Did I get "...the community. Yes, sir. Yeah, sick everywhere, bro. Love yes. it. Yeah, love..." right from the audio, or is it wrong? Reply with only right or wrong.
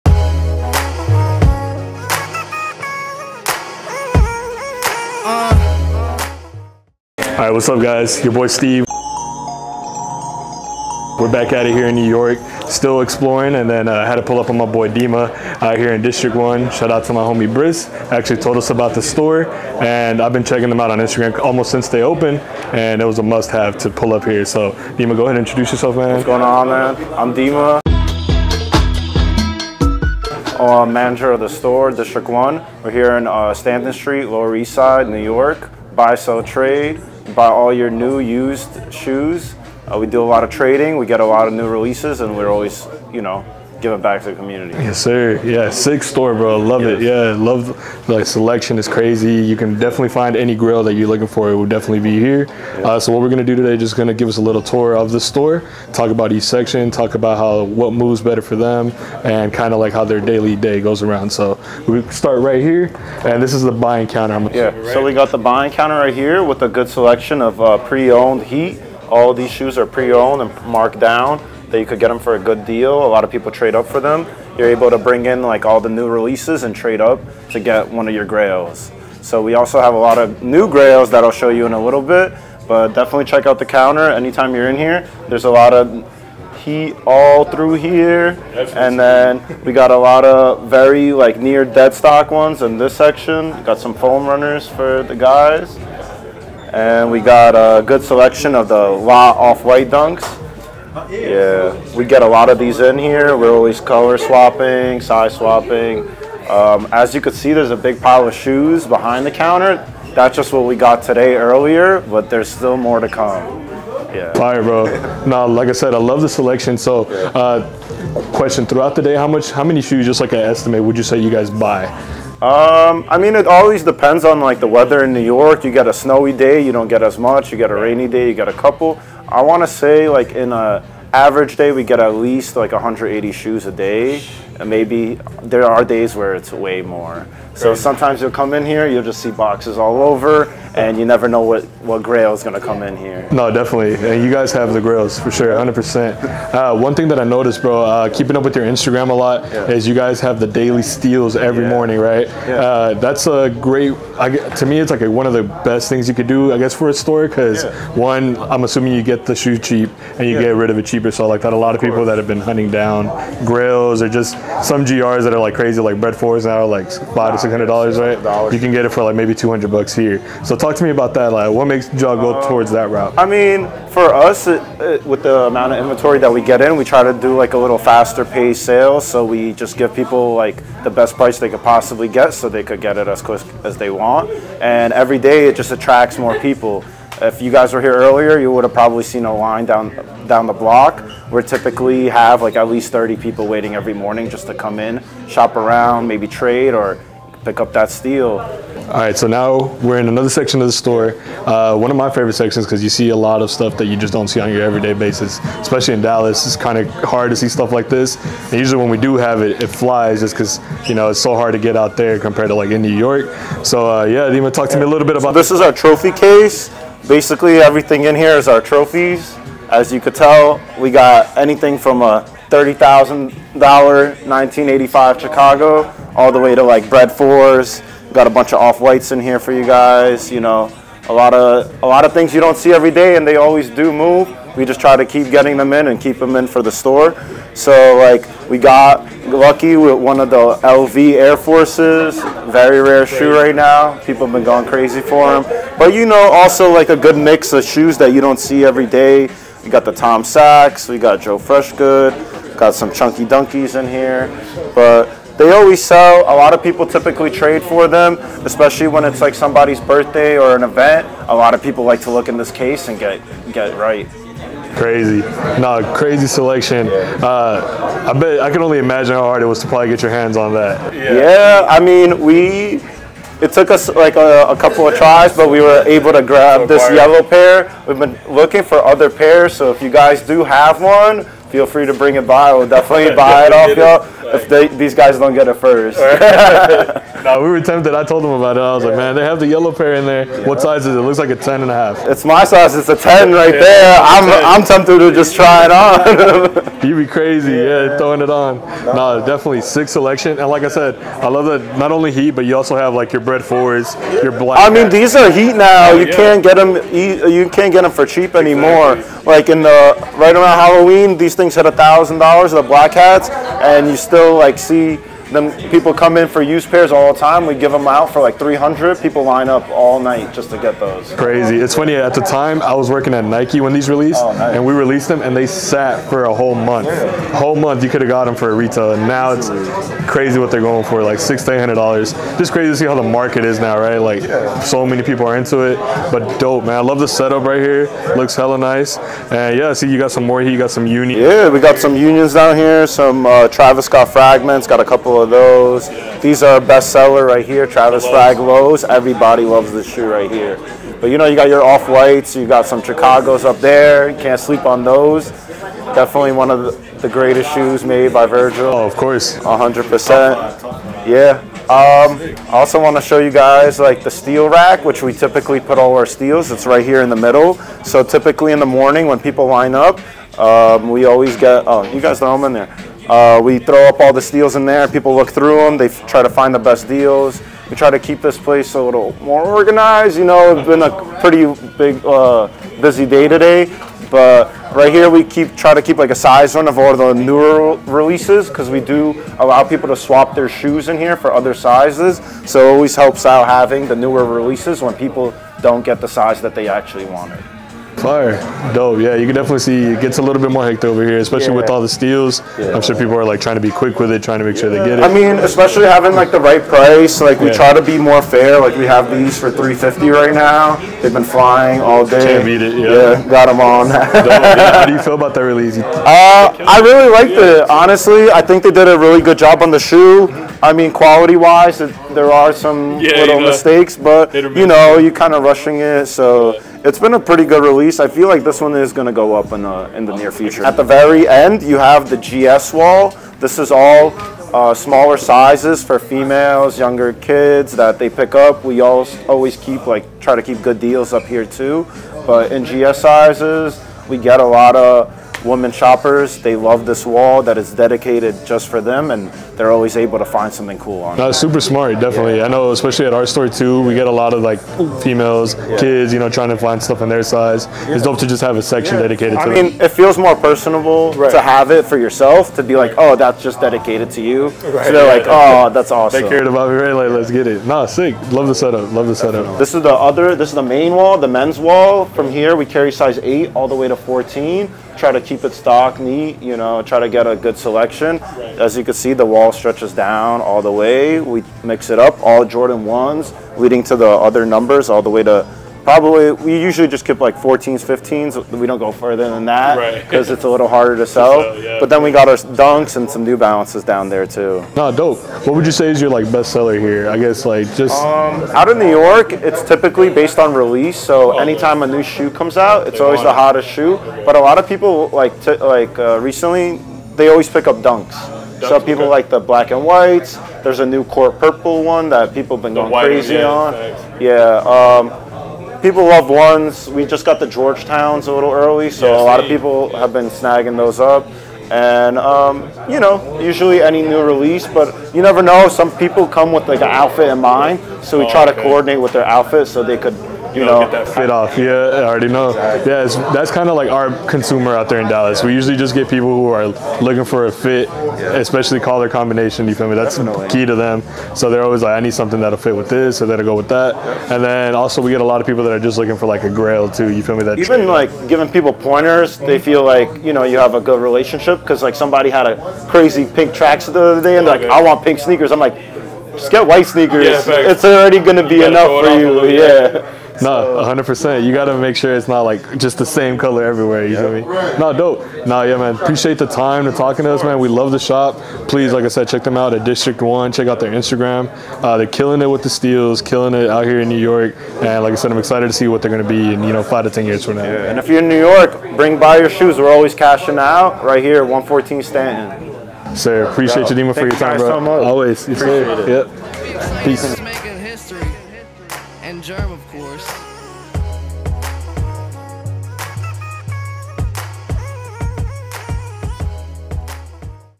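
wrong.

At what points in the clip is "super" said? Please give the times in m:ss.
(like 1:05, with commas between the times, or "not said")
7:31.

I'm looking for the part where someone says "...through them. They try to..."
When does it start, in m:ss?
6:15.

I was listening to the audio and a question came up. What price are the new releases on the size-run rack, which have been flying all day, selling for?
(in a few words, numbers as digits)
350.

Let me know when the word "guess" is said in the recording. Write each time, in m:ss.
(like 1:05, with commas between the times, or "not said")
2:36, 8:17.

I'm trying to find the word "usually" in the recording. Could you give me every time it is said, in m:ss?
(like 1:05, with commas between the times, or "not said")
3:28, 8:06, 8:43, 8:55.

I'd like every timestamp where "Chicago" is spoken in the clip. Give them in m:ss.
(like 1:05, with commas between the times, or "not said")
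3:45, 5:52.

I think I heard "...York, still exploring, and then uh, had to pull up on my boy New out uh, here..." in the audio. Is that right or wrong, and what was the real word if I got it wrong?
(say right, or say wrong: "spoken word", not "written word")
wrong: "Dima", not "New".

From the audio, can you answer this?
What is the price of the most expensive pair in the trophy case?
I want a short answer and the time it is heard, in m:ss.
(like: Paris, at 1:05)
$30,000, at 3:42.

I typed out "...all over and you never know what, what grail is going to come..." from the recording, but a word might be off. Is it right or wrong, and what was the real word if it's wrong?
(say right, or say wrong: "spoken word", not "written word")
right.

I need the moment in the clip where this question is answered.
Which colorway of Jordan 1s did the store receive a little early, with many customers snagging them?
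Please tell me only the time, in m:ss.
8:37.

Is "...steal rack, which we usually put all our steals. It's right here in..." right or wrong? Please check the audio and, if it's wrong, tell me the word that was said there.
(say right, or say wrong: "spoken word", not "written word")
wrong: "typically", not "usually".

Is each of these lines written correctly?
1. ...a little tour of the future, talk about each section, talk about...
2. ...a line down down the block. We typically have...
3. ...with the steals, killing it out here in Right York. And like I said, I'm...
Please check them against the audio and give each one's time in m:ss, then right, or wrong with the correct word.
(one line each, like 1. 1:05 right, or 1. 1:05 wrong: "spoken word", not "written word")
1. 0:54 wrong: "store", not "future"
2. 3:09 right
3. 9:32 wrong: "New", not "Right".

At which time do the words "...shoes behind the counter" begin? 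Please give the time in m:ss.
1:48.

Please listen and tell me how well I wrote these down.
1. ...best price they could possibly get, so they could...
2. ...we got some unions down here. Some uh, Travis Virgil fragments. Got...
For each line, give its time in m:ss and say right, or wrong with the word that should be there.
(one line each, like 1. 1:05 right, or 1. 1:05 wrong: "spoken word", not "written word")
1. 3:00 right
2. 5:41 wrong: "Scott", not "Virgil".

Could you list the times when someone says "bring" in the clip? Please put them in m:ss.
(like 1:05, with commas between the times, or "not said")
1:14, 4:41, 9:38.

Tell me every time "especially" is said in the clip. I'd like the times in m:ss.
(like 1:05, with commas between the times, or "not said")
3:25, 4:18, 6:41, 6:45, 7:32, 8:58.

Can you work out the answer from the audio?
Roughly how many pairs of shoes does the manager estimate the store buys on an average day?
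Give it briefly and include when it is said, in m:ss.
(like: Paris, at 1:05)
180, at 2:12.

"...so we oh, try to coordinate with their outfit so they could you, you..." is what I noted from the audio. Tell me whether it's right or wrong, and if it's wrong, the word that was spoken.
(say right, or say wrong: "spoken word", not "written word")
right.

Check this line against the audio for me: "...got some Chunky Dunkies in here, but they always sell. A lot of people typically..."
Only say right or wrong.
right.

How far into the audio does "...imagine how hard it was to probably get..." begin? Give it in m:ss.
4:28.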